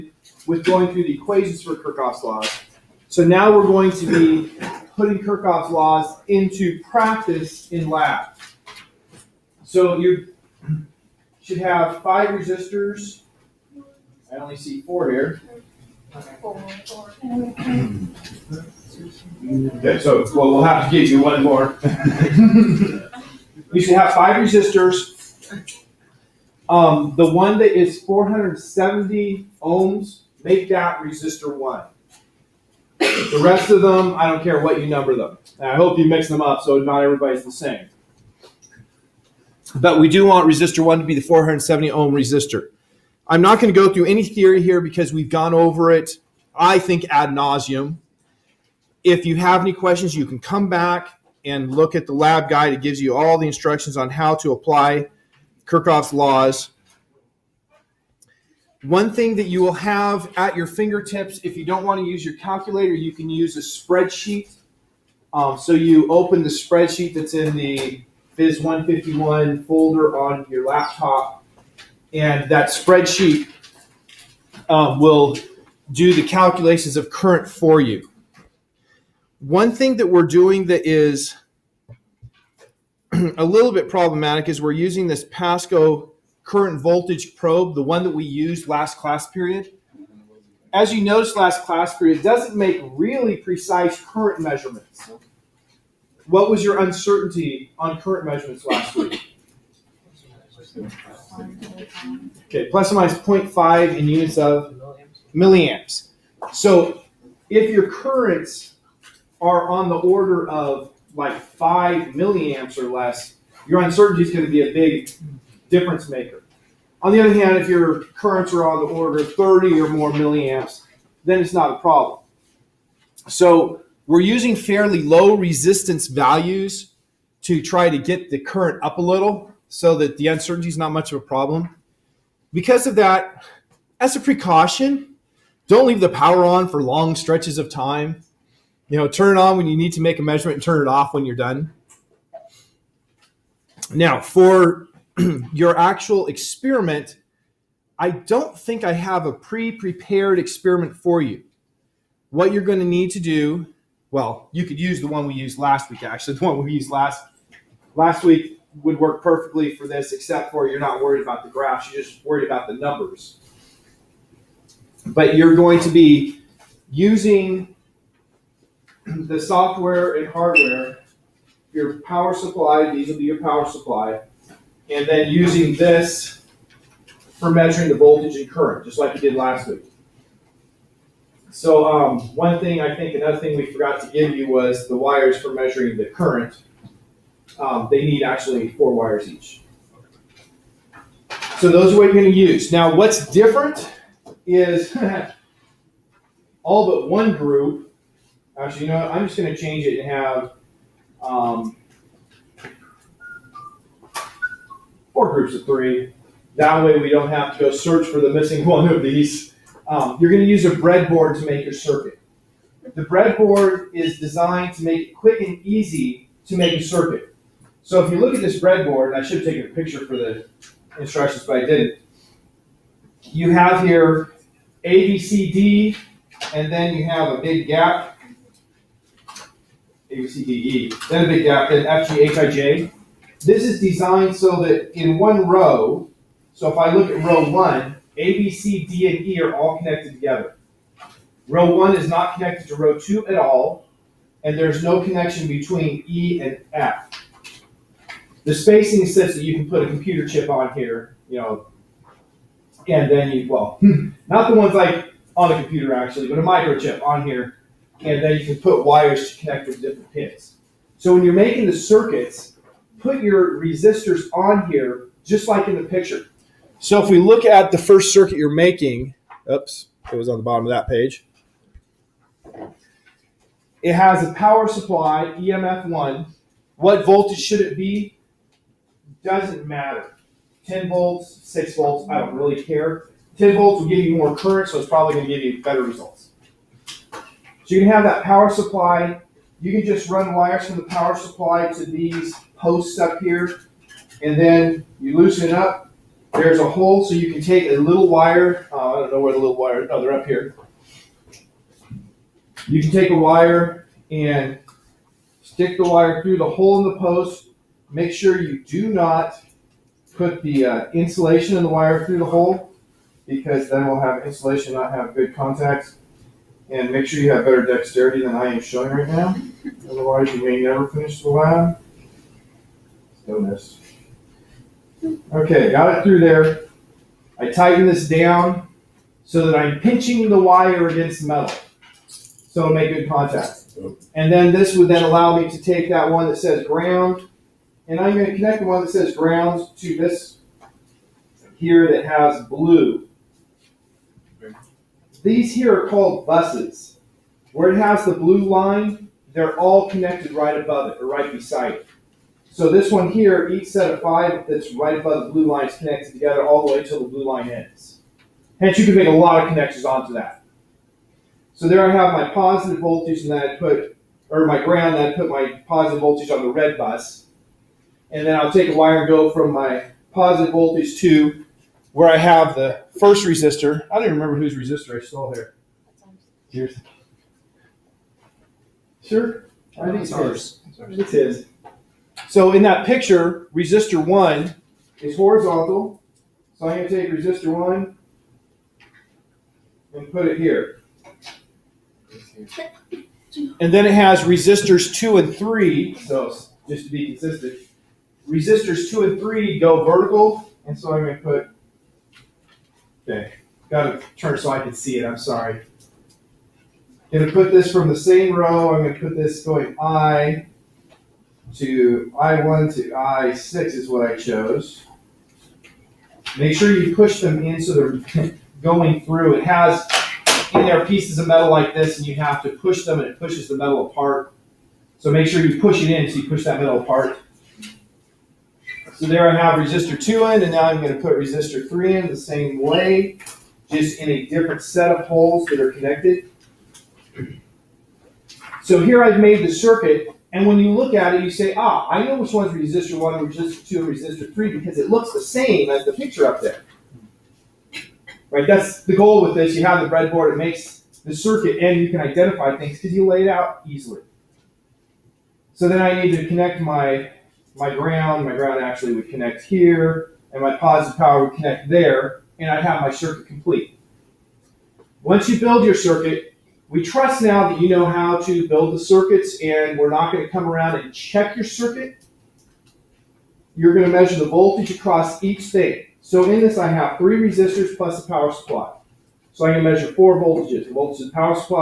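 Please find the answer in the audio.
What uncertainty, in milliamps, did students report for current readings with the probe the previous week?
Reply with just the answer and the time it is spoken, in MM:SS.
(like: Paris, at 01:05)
0.5, at 01:43.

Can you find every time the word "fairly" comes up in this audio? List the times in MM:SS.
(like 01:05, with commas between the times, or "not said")
02:04.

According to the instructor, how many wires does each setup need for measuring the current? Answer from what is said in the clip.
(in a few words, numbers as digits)
4.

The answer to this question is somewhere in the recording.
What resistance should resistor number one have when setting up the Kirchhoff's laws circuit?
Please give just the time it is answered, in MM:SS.
00:28.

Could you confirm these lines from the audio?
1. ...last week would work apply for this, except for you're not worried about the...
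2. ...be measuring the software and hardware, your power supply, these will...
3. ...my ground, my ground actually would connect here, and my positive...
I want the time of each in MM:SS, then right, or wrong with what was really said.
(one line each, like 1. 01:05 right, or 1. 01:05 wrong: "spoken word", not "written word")
1. 02:37 wrong: "perfectly", not "apply"
2. 02:45 wrong: "using", not "measuring"
3. 07:37 right.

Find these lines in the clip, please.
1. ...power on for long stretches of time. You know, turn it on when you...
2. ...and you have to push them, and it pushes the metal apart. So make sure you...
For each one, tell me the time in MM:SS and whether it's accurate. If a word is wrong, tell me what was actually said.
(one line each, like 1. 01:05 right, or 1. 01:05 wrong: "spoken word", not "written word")
1. 02:16 right
2. 07:01 right.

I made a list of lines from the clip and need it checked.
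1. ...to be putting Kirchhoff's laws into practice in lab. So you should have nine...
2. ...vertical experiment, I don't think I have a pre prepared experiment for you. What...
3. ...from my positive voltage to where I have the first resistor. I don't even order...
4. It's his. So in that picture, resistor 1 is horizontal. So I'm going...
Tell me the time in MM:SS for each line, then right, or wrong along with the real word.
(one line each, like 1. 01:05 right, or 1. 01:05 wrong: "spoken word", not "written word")
1. 00:03 wrong: "five", not "nine"
2. 02:25 wrong: "actual", not "vertical"
3. 06:09 wrong: "remember", not "order"
4. 06:20 right.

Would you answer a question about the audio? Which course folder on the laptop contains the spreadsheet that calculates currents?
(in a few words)
Phys 151.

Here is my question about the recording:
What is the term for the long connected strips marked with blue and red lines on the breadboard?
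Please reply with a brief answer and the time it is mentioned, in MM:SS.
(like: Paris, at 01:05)
buses, at 05:46.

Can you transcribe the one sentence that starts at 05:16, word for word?
And make sure you have better dexterity than I am showing right now.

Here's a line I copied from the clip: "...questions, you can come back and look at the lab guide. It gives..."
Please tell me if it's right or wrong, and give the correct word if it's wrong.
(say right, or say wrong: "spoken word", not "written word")
right.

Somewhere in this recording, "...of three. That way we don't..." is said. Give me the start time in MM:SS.
03:25.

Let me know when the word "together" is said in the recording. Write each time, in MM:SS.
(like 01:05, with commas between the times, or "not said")
04:00, 05:56.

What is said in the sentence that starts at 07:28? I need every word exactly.
Right, that's the goal with this.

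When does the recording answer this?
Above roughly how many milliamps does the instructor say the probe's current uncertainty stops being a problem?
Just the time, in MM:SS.
01:59.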